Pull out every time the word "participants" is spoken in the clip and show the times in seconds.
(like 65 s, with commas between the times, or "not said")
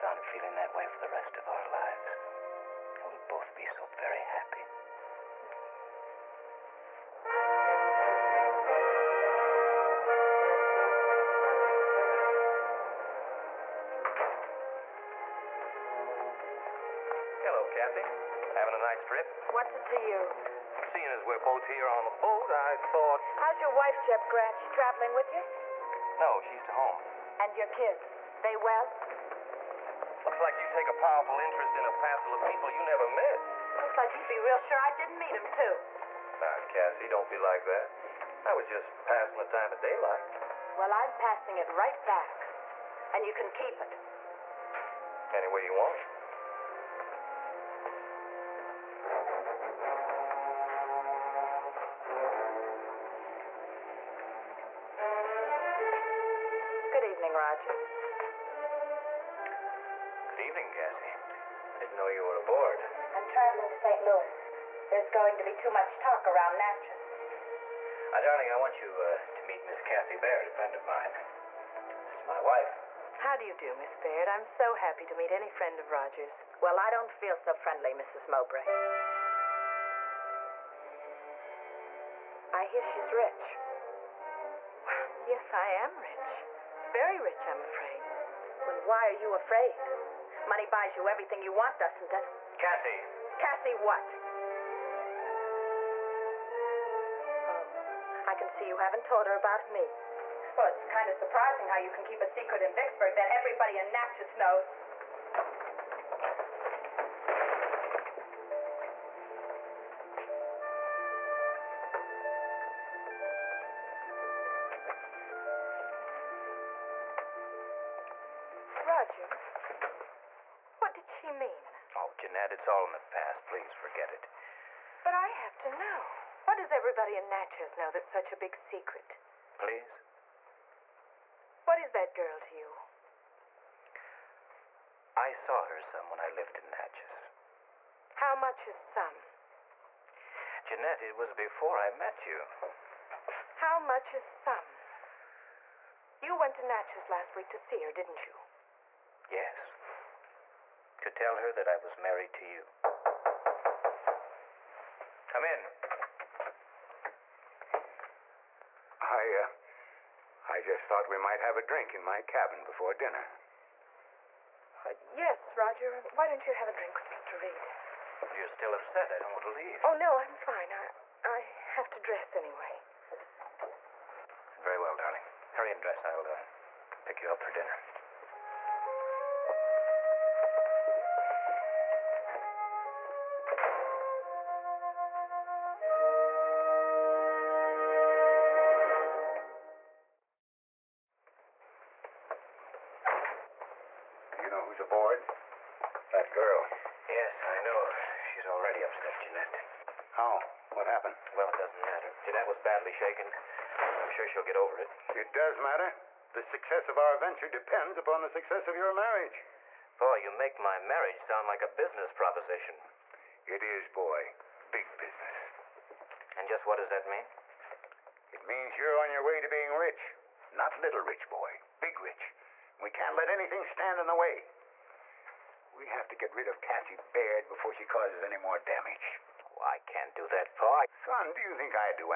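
not said.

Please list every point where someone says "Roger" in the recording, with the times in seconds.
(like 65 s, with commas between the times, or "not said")
75 s, 118 s, 165 s.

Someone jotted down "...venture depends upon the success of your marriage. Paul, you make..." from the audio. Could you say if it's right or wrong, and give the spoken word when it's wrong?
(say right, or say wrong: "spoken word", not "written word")
right.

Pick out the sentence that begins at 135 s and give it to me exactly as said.
I saw her some when I lived in Natchez.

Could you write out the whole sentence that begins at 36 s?
Now, Cassie, don't be like that.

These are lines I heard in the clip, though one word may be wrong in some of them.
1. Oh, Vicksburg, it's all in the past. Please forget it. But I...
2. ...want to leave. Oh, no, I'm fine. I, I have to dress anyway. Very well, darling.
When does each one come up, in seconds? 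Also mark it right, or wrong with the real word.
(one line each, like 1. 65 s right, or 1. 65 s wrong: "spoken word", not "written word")
1. 121 s wrong: "Jeanette", not "Vicksburg"
2. 169 s right.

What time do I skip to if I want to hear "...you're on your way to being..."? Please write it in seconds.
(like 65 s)
218 s.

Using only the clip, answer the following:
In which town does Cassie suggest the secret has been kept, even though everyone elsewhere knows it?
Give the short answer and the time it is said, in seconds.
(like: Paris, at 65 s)
Vicksburg, at 102 s.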